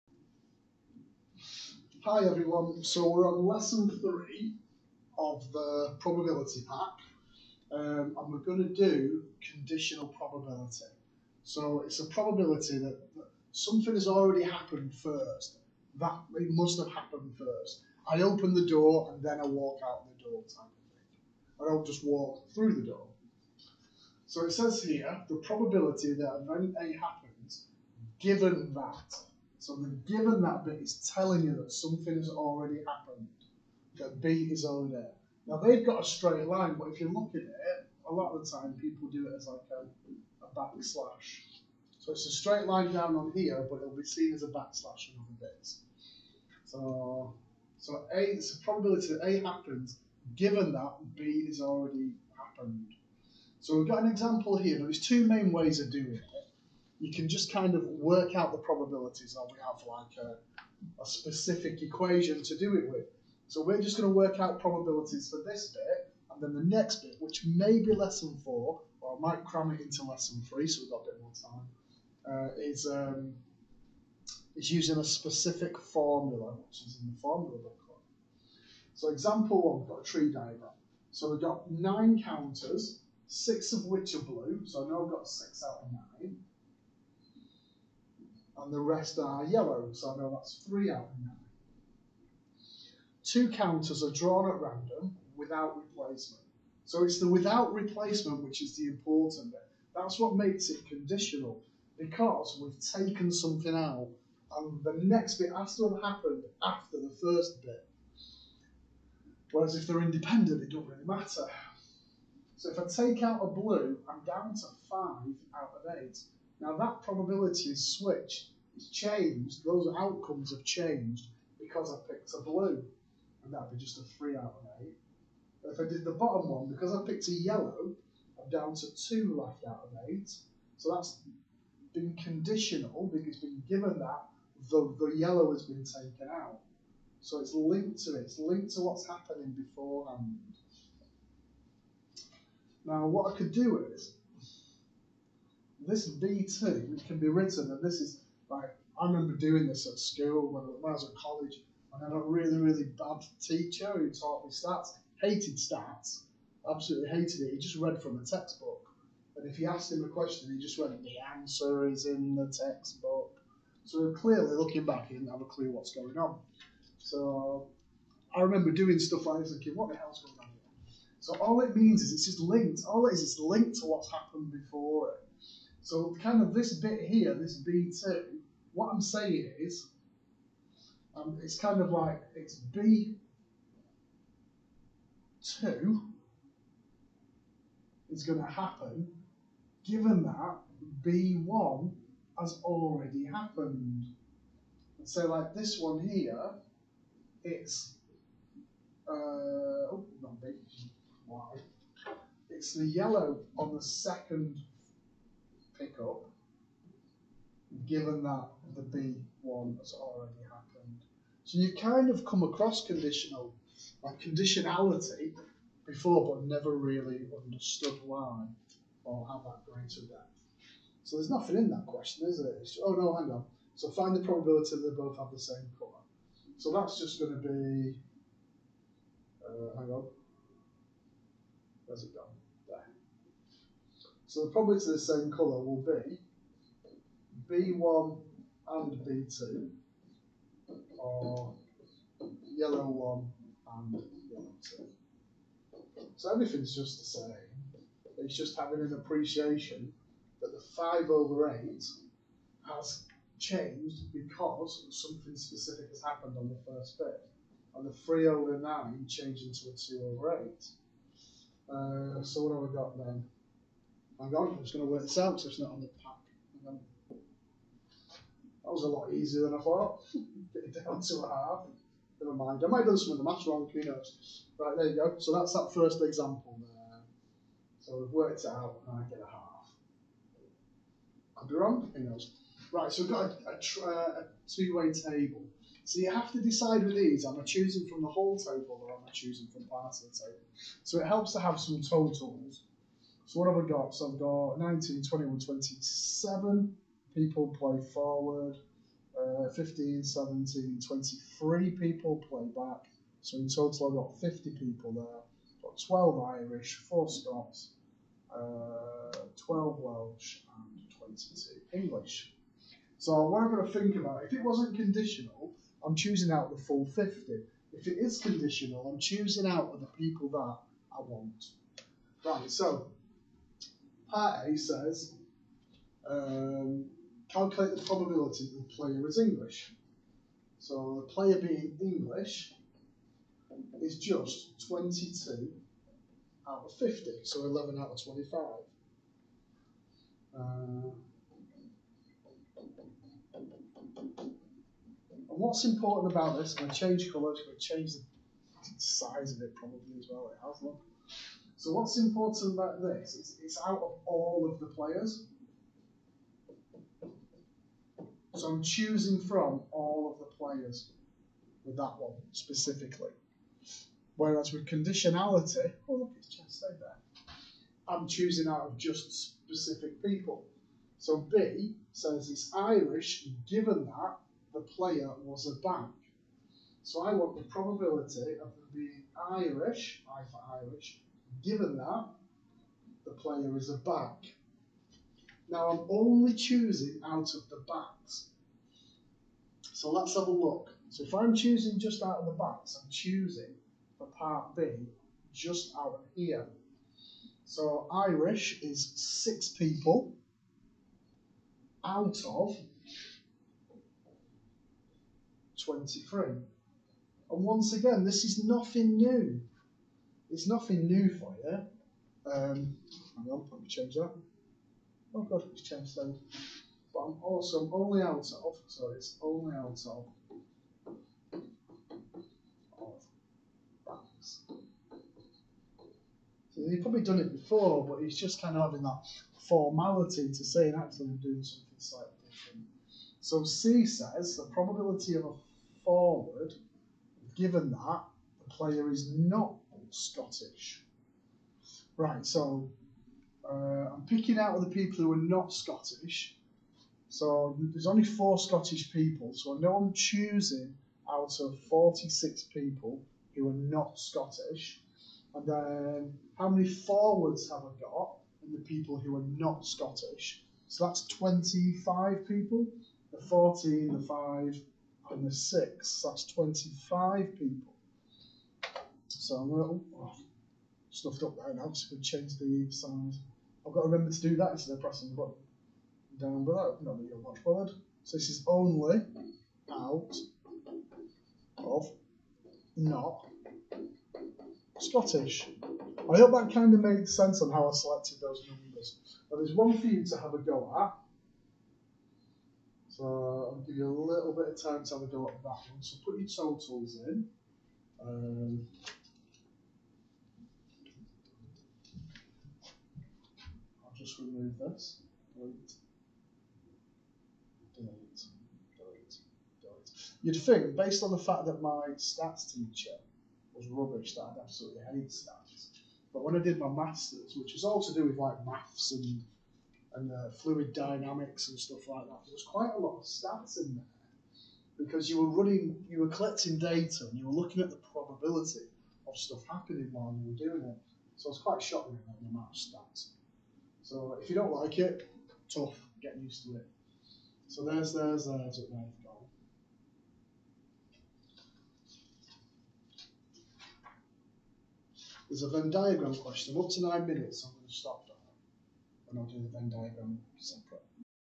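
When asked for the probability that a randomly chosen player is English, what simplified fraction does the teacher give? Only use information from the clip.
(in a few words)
11/25.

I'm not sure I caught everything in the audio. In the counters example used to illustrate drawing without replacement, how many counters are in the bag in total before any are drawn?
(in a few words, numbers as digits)
9.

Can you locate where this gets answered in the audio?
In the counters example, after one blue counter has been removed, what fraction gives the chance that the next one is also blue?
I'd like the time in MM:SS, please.
01:54.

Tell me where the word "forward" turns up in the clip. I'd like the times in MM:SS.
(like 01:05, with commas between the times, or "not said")
04:57, 07:15, 07:36.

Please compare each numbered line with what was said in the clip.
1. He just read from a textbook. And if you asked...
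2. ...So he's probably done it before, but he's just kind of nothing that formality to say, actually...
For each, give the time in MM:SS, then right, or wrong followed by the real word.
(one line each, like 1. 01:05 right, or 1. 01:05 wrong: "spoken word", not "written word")
1. 02:37 right
2. 07:06 wrong: "having", not "nothing".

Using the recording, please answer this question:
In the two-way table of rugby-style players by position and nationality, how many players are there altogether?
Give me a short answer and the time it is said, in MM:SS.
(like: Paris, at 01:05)
50, at 05:04.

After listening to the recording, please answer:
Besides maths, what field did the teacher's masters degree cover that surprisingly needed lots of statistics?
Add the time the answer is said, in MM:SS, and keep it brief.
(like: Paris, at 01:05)
Fluid dynamics, at 08:40.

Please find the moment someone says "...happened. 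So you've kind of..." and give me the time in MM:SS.
03:30.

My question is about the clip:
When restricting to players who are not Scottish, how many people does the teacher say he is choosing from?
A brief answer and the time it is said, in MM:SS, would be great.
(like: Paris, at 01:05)
46, at 07:31.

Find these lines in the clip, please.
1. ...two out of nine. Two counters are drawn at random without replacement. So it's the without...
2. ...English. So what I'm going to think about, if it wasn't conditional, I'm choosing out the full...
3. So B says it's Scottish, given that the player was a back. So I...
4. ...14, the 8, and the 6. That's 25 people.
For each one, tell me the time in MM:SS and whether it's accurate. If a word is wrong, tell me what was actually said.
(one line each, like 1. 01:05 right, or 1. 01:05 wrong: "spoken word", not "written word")
1. 01:30 wrong: "three", not "two"
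2. 05:11 right
3. 06:10 wrong: "Irish", not "Scottish"
4. 07:43 wrong: "5", not "8".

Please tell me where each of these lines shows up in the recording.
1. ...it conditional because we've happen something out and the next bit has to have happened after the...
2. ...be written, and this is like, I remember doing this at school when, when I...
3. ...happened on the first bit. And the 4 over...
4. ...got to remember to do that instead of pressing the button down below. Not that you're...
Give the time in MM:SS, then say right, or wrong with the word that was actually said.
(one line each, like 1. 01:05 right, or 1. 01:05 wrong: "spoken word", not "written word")
1. 01:40 wrong: "taken", not "happen"
2. 02:27 right
3. 04:16 wrong: "3", not "4"
4. 07:53 right.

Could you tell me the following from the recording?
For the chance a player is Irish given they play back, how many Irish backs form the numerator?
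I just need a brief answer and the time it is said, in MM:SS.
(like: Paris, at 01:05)
6, at 06:38.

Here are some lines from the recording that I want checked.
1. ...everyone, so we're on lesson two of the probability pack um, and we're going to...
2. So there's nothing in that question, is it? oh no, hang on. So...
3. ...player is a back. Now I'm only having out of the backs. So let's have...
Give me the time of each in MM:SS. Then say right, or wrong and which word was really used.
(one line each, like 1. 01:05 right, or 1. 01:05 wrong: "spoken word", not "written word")
1. 00:02 wrong: "three", not "two"
2. 03:41 right
3. 06:23 wrong: "choosing", not "having".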